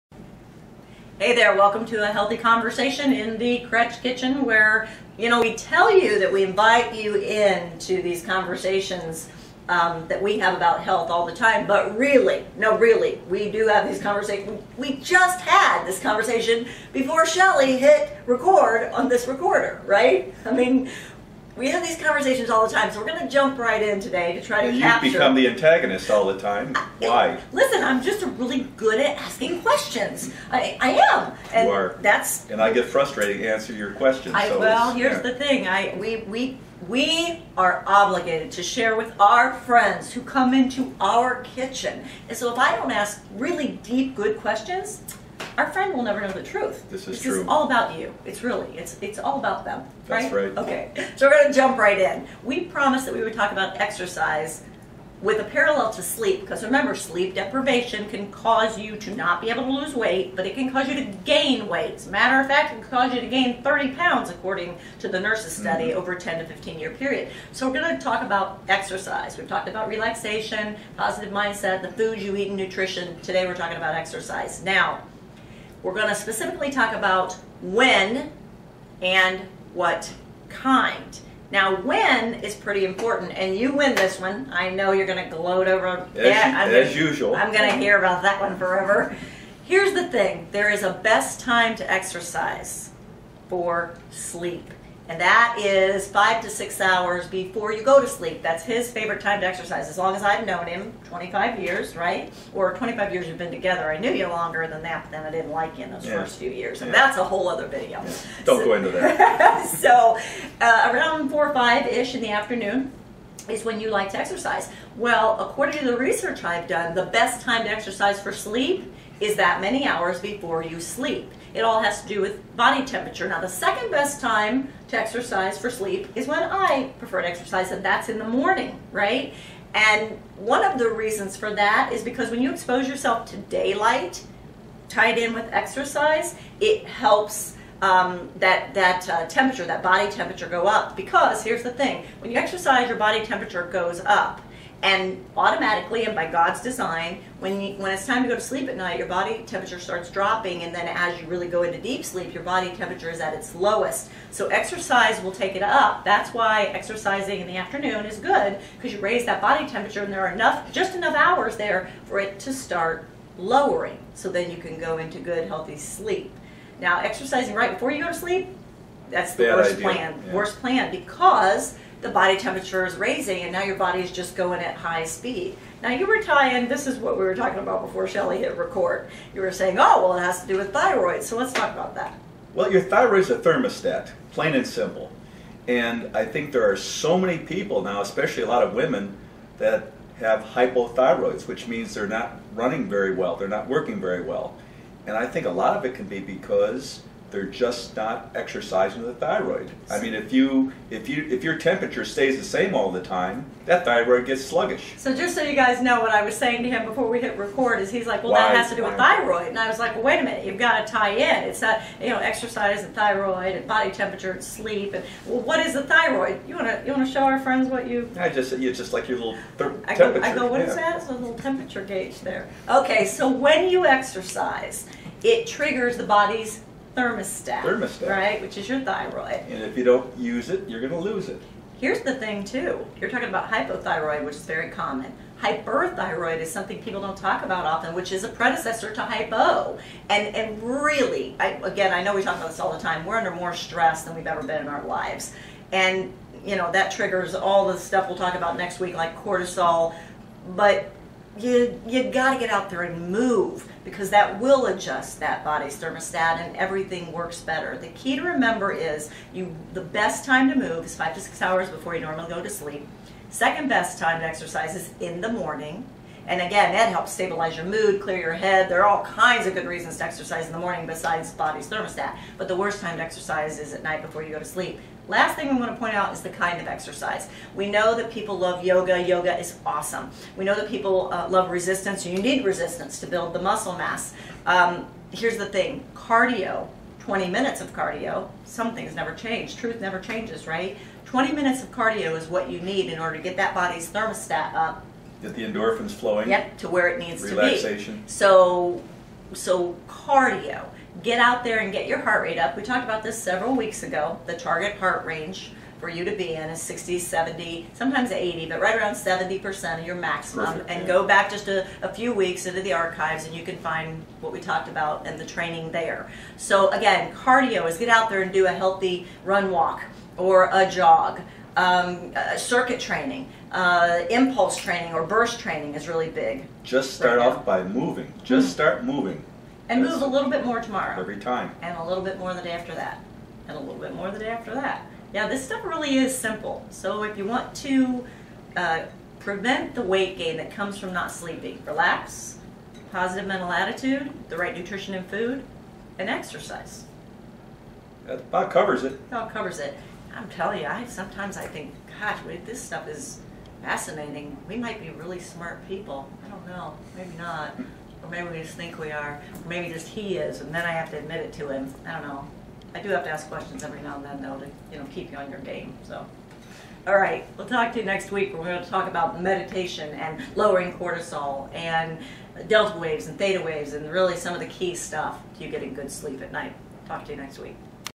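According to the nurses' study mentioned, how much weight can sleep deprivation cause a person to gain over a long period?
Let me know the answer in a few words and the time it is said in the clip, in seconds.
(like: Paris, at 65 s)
30 pounds, at 63 s.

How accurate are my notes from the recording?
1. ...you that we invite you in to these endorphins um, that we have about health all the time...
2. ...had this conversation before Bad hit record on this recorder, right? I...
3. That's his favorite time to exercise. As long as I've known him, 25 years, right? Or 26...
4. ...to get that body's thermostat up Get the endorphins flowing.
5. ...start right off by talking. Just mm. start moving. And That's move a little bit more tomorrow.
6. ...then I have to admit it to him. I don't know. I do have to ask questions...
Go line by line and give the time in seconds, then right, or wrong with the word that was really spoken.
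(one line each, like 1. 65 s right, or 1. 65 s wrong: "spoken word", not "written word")
1. 5 s wrong: "conversations", not "endorphins"
2. 15 s wrong: "Shelly", not "Bad"
3. 98 s wrong: "25", not "26"
4. 293 s right
5. 326 s wrong: "moving", not "talking"
6. 360 s right.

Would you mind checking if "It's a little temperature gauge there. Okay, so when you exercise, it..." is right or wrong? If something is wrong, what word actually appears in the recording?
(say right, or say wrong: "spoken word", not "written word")
right.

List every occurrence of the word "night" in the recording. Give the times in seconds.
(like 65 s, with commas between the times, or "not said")
148 s, 273 s, 376 s.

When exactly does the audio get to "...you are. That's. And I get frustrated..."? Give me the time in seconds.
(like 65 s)
31 s.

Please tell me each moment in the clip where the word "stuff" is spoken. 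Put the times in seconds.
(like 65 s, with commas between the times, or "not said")
247 s, 335 s, 352 s, 374 s.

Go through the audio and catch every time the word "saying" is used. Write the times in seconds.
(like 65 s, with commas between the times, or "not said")
179 s, 206 s.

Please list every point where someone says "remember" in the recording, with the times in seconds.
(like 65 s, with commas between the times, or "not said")
56 s, 258 s.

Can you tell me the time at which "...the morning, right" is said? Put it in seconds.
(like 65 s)
128 s.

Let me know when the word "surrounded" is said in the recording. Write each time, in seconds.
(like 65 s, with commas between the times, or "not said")
not said.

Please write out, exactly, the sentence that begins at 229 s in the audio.
And if you don't use it, you're going to lose it.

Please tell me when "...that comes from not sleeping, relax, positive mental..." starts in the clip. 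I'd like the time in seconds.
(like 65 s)
340 s.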